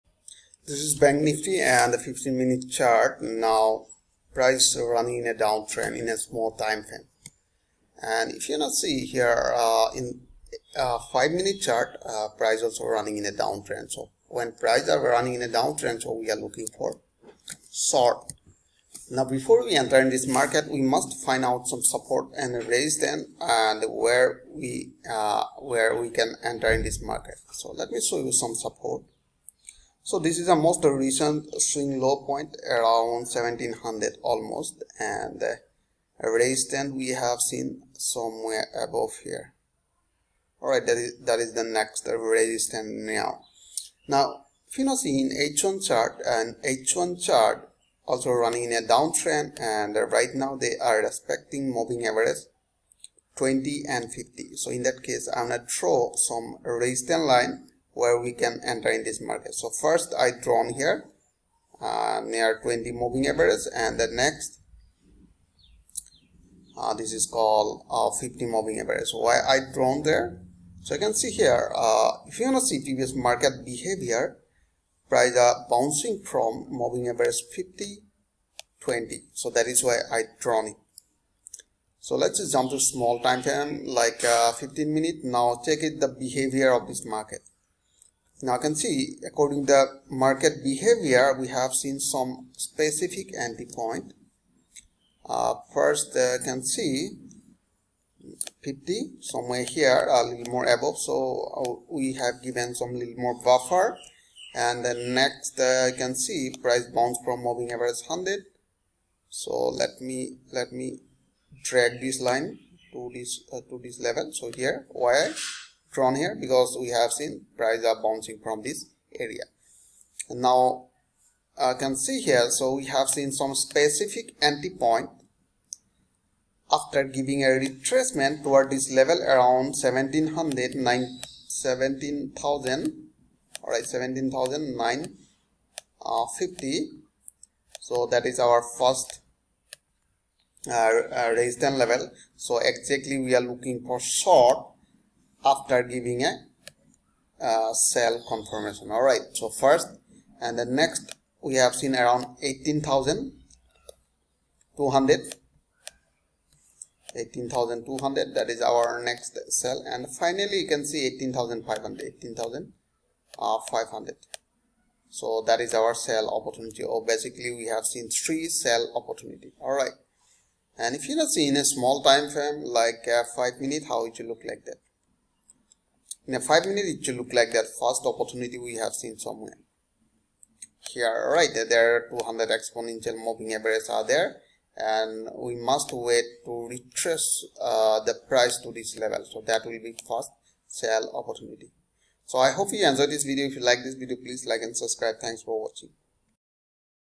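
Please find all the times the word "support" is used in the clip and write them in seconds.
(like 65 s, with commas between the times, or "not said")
21 s, 28 s.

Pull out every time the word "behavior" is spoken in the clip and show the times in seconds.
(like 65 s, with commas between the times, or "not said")
73 s, 86 s, 90 s.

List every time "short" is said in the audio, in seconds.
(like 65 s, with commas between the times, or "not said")
17 s, 143 s.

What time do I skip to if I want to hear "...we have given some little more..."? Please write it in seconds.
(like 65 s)
101 s.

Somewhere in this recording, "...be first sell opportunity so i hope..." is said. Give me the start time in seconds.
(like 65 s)
189 s.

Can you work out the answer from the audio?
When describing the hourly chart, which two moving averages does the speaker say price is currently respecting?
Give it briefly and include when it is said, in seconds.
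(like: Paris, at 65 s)
20 and 50, at 53 s.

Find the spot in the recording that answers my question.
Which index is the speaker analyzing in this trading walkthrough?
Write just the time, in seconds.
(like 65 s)
0 s.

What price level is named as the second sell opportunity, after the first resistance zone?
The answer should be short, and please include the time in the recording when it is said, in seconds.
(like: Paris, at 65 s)
18,200, at 152 s.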